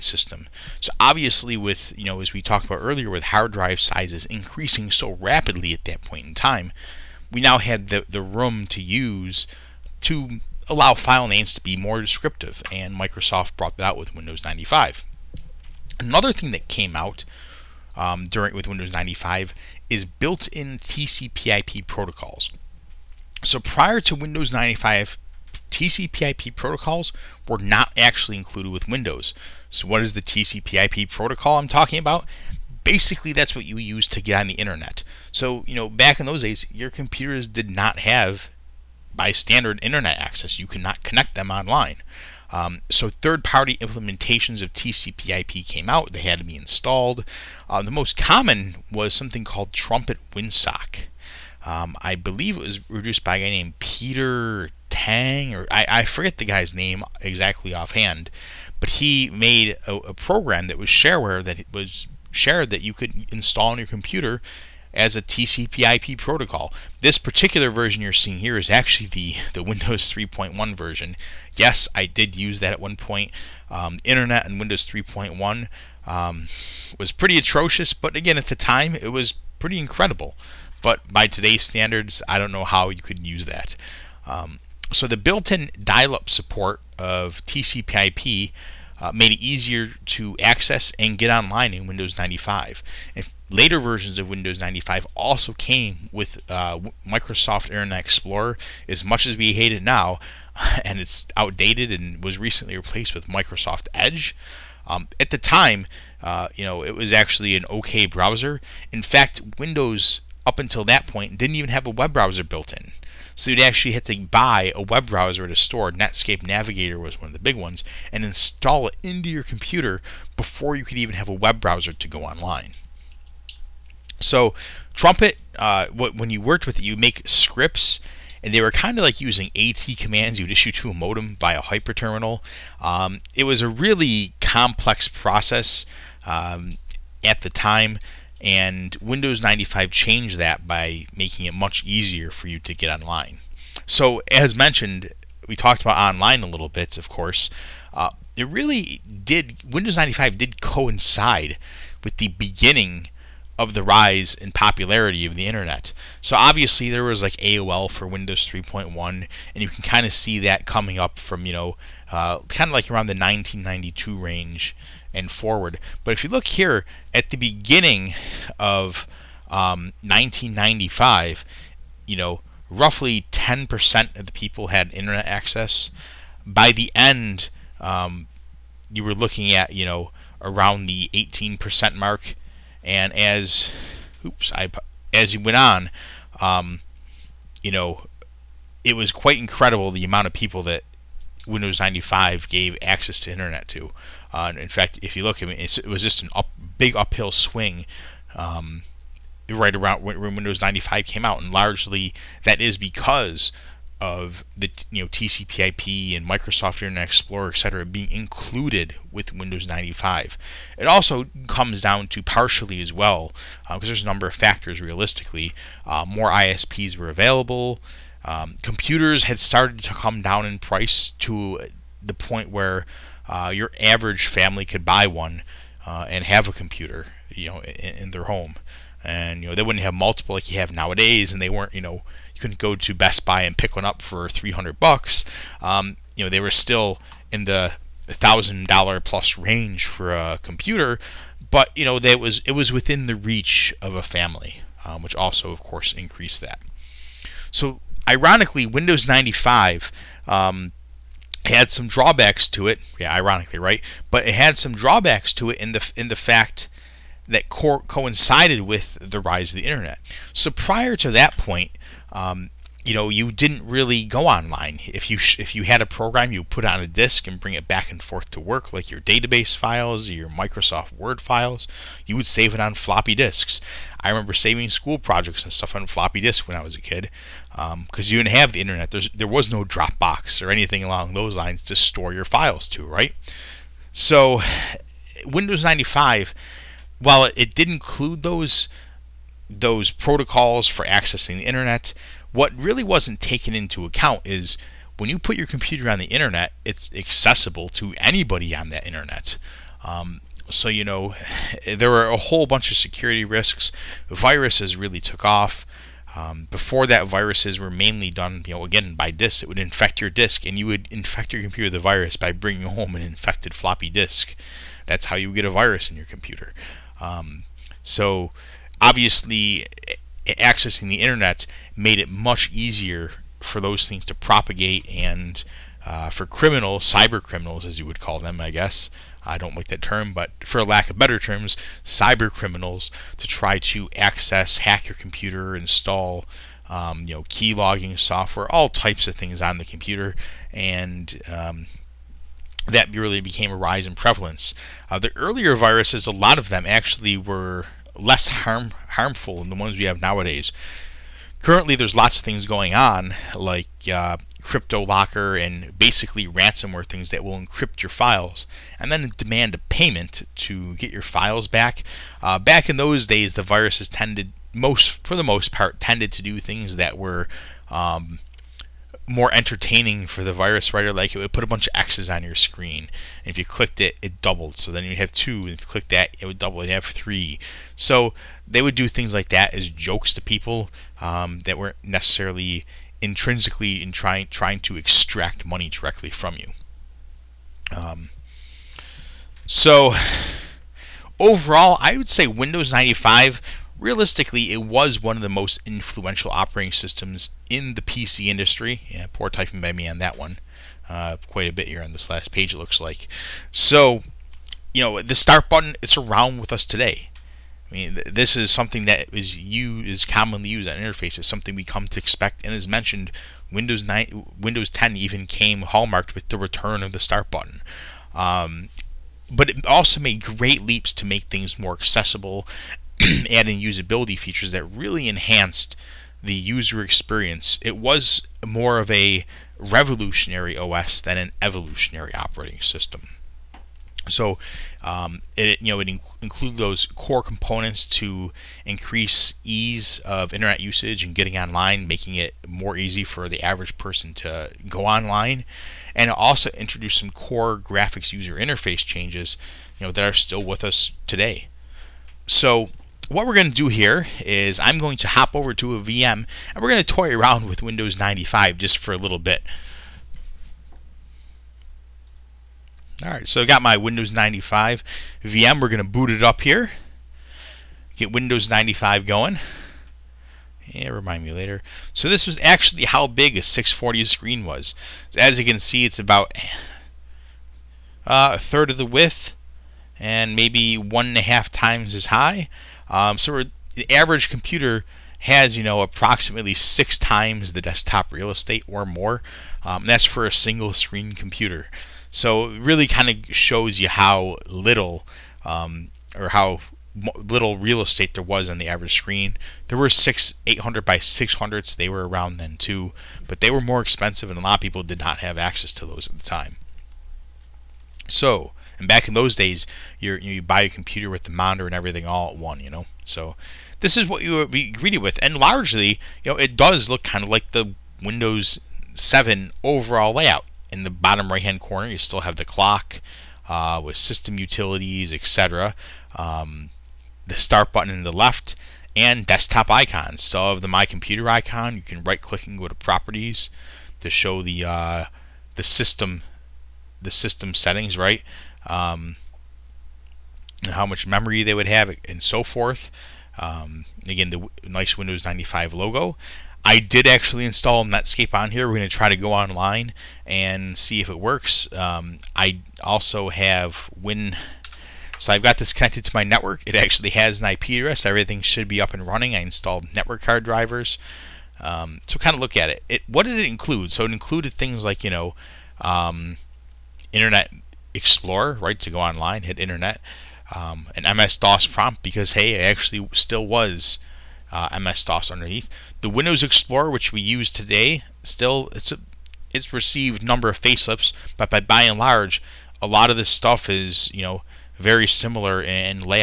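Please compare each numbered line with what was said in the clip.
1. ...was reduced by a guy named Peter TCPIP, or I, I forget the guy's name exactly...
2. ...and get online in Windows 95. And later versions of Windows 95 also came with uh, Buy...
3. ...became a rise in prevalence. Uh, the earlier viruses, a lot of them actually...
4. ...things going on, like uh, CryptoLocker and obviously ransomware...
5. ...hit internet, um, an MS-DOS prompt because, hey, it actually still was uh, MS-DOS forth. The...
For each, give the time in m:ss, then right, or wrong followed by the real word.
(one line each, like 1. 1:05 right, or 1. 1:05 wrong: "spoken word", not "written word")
1. 0:52 wrong: "Tang", not "TCPIP"
2. 1:30 wrong: "Microsoft", not "Buy"
3. 5:43 right
4. 5:52 wrong: "basically", not "obviously"
5. 9:29 wrong: "underneath", not "forth".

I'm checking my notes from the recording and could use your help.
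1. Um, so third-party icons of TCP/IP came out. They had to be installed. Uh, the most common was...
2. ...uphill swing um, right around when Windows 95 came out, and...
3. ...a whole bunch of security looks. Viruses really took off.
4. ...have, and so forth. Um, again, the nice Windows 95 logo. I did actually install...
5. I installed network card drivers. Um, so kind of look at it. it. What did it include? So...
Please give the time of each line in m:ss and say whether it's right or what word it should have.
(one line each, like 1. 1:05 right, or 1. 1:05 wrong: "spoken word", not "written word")
1. 0:42 wrong: "implementations", not "icons"
2. 3:16 right
3. 5:02 wrong: "risks", not "looks"
4. 9:01 right
5. 9:19 right.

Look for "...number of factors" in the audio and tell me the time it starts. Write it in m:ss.
3:34.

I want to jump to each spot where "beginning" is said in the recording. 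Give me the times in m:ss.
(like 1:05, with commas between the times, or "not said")
2:32, 2:47.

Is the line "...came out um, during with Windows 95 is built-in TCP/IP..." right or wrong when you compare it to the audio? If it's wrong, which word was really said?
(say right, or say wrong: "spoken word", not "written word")
right.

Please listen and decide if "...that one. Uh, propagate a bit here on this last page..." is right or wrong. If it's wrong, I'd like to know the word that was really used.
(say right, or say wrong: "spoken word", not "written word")
wrong: "quite", not "propagate".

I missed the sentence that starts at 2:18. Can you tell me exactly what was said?
And Windows 95 changed that by making it much easier for you to get online.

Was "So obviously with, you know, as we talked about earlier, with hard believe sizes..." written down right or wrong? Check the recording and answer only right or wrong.
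wrong.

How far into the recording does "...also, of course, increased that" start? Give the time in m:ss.
4:05.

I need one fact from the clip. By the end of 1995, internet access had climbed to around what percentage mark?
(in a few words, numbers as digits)
18%.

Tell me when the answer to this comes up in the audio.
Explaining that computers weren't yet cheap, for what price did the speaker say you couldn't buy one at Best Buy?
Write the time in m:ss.
3:54.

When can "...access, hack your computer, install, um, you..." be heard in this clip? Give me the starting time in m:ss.
5:33.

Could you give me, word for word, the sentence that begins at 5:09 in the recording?
It would infect your disk, and you would infect your computer with the virus by bringing home an infected floppy disk.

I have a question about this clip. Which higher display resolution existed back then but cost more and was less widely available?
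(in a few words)
800 by 600.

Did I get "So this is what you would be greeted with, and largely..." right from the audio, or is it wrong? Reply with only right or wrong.
right.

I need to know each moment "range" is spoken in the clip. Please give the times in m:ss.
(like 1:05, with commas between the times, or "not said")
2:44, 3:59.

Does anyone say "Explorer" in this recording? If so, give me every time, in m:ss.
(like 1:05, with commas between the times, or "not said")
1:37, 3:27, 9:27, 9:36.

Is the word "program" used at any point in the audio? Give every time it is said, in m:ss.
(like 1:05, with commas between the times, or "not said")
1:00, 4:25.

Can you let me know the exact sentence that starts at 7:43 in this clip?
All right, so I got my Windows 95 VM.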